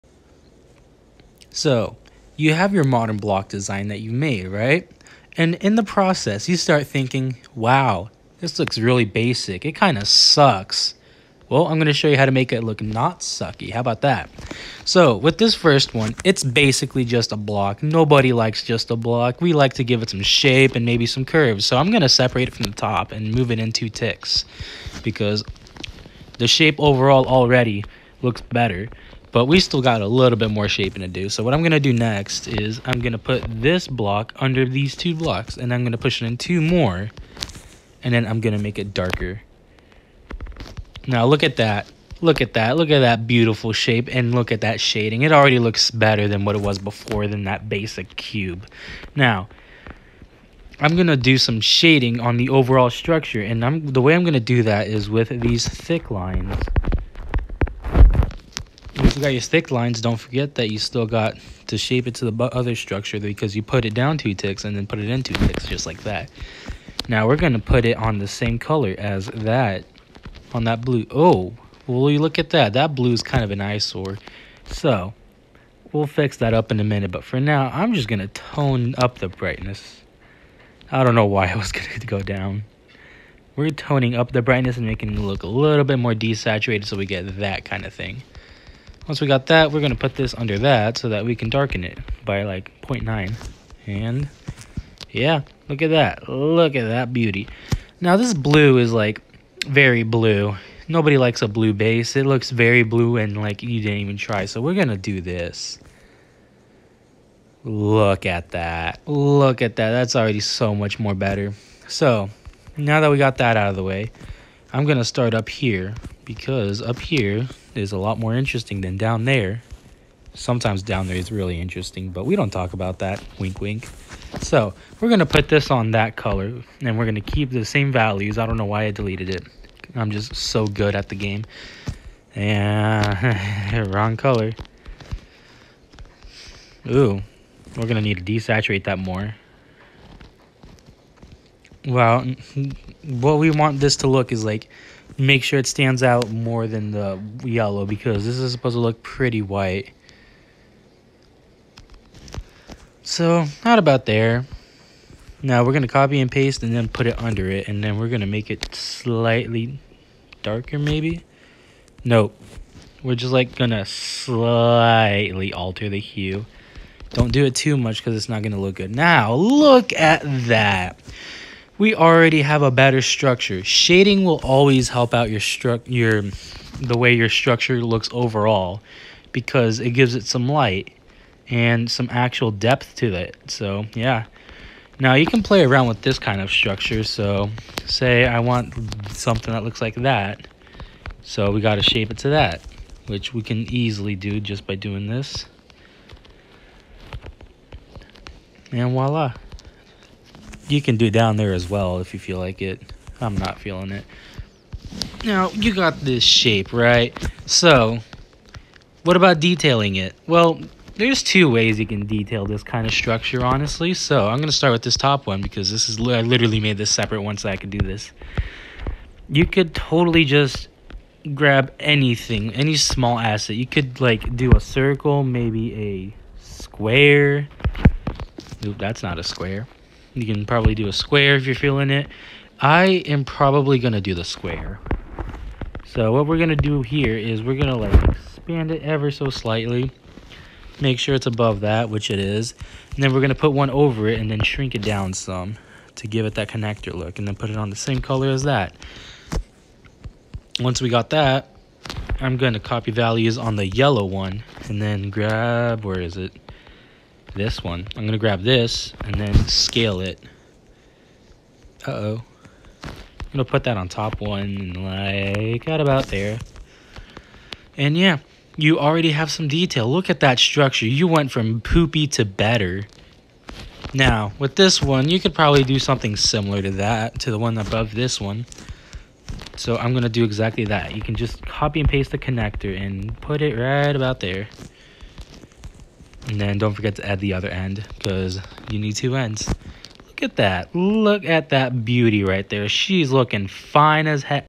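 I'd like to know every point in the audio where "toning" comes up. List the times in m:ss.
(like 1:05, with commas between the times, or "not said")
1:23.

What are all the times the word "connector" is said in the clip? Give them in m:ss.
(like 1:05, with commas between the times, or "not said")
4:06, 4:42.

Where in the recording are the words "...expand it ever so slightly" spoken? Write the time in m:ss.
3:58.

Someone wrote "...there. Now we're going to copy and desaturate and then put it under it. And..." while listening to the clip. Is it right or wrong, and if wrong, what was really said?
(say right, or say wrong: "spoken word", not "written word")
wrong: "paste", not "desaturate".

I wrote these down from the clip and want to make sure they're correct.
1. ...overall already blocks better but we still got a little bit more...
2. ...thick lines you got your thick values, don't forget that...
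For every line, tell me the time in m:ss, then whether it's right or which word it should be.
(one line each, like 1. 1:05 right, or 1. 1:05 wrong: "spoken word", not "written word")
1. 0:26 wrong: "looks", not "blocks"
2. 0:55 wrong: "lines", not "values".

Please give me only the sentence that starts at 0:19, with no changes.
We like to give it some shape and maybe some curves.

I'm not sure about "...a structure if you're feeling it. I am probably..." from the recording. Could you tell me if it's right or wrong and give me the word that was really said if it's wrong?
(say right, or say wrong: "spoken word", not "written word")
wrong: "square", not "structure".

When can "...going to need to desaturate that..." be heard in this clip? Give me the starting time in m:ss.
2:17.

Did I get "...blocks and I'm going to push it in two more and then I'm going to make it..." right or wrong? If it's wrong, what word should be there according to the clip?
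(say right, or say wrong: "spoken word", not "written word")
right.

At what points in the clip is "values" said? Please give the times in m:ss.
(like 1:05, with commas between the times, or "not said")
2:07, 4:12.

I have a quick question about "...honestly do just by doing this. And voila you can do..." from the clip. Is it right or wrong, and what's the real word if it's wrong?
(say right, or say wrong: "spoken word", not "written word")
wrong: "easily", not "honestly".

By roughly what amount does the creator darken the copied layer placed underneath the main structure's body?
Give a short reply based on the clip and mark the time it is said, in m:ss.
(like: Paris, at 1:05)
0.9, at 1:32.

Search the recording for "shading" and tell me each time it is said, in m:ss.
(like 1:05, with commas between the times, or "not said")
0:44, 0:51, 2:53.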